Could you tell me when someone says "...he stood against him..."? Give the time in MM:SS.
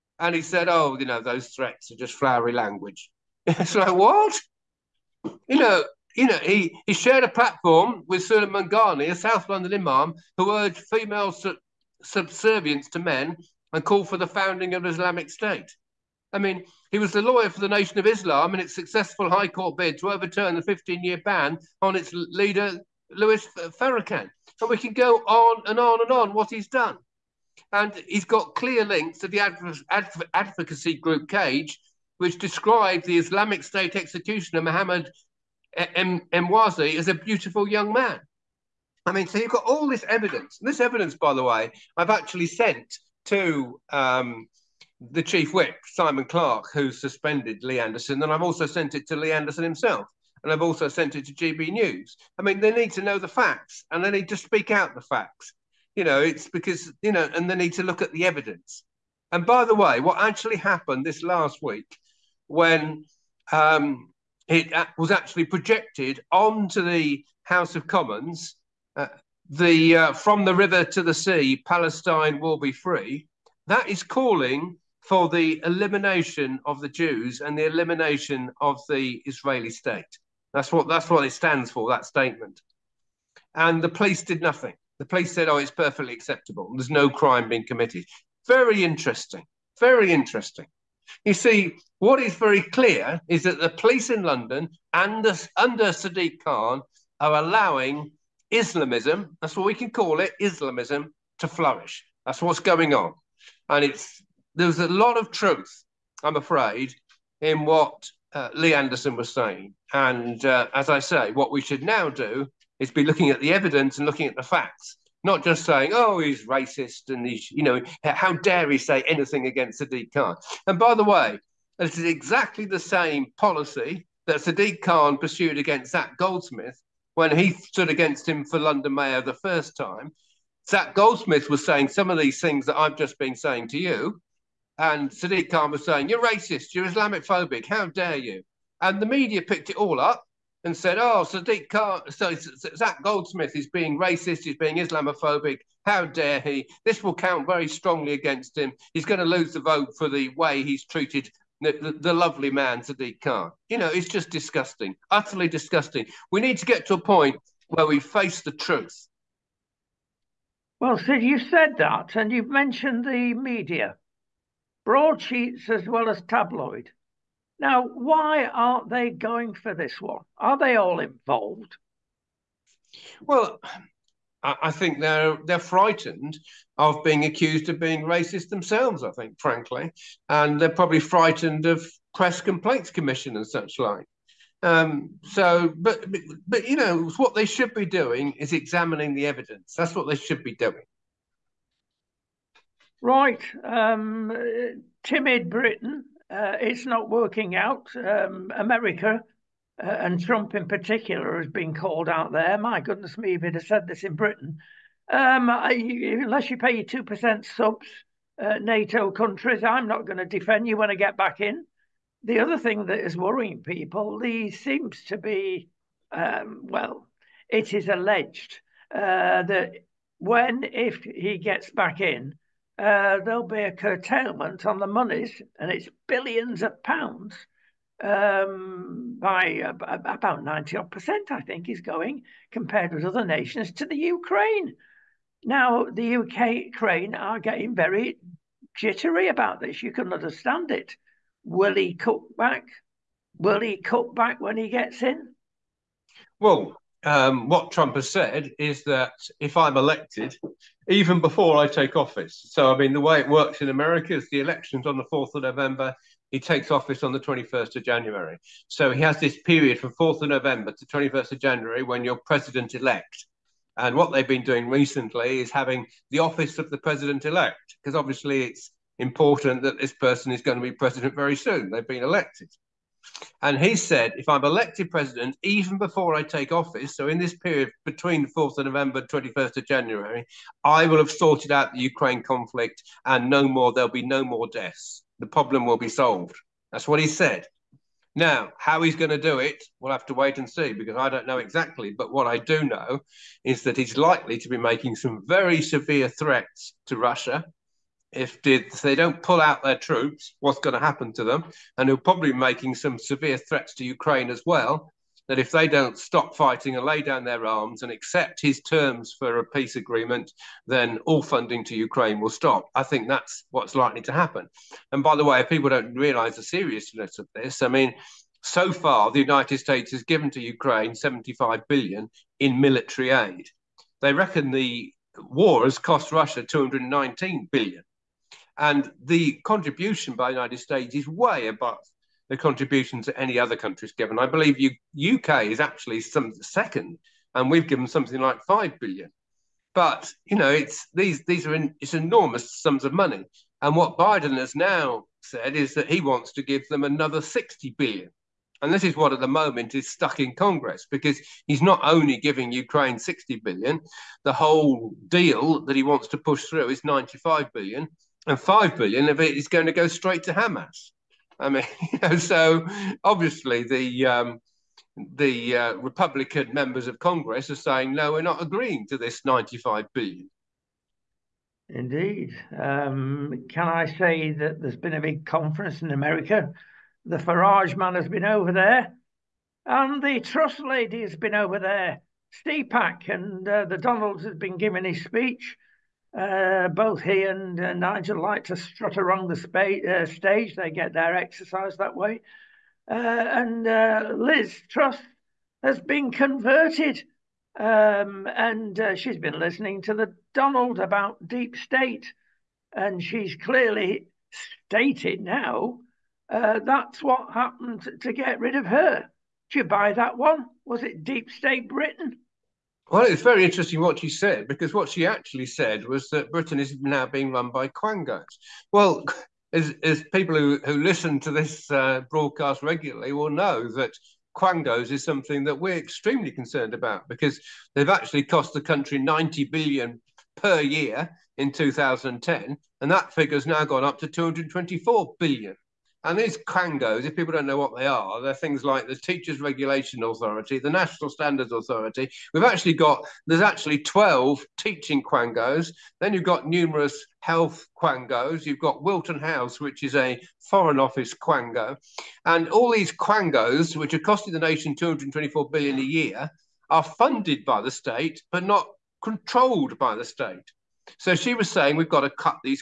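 02:07.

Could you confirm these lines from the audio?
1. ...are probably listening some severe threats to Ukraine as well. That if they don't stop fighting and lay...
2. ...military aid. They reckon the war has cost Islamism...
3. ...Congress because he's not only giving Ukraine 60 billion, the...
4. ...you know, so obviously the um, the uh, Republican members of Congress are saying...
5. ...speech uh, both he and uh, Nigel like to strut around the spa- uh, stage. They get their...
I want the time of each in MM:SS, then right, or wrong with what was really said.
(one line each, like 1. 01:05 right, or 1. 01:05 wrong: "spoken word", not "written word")
1. 05:01 wrong: "making", not "listening"
2. 05:22 wrong: "Russia", not "Islamism"
3. 05:50 right
4. 06:01 right
5. 06:25 right.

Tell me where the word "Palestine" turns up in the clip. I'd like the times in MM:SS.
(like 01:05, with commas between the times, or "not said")
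01:11.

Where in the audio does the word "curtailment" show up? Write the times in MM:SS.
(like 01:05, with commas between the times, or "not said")
03:43.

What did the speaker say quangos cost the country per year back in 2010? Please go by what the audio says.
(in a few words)
90 billion.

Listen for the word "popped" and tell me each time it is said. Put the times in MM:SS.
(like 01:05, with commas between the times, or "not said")
not said.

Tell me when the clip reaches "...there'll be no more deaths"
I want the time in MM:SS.
04:43.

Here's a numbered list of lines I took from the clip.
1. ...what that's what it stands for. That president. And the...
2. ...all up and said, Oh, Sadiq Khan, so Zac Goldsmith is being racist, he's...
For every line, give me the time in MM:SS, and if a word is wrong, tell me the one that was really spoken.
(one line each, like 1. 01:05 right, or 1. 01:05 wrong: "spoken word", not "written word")
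1. 01:20 wrong: "statement", not "president"
2. 02:19 right.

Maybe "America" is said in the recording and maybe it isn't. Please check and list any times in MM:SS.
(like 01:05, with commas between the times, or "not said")
03:18, 04:13, 06:15.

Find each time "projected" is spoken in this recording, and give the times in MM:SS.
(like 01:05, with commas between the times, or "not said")
01:05.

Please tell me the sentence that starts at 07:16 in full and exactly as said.
And these quangos, if people don't know what they are, they're things like the Teachers Regulation Authority, the National Standards Authority.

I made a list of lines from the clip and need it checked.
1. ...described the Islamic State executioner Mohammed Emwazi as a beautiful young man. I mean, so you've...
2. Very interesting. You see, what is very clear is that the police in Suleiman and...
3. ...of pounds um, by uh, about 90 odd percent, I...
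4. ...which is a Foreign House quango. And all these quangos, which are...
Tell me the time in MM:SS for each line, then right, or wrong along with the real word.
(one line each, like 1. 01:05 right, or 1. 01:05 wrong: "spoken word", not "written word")
1. 00:32 right
2. 01:29 wrong: "London", not "Suleiman"
3. 03:46 right
4. 07:29 wrong: "Office", not "House".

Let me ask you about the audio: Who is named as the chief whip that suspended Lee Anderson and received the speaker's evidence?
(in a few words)
Simon Clark.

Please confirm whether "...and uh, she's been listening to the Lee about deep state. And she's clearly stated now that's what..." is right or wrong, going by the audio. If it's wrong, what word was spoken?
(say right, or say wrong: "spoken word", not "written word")
wrong: "Donald", not "Lee".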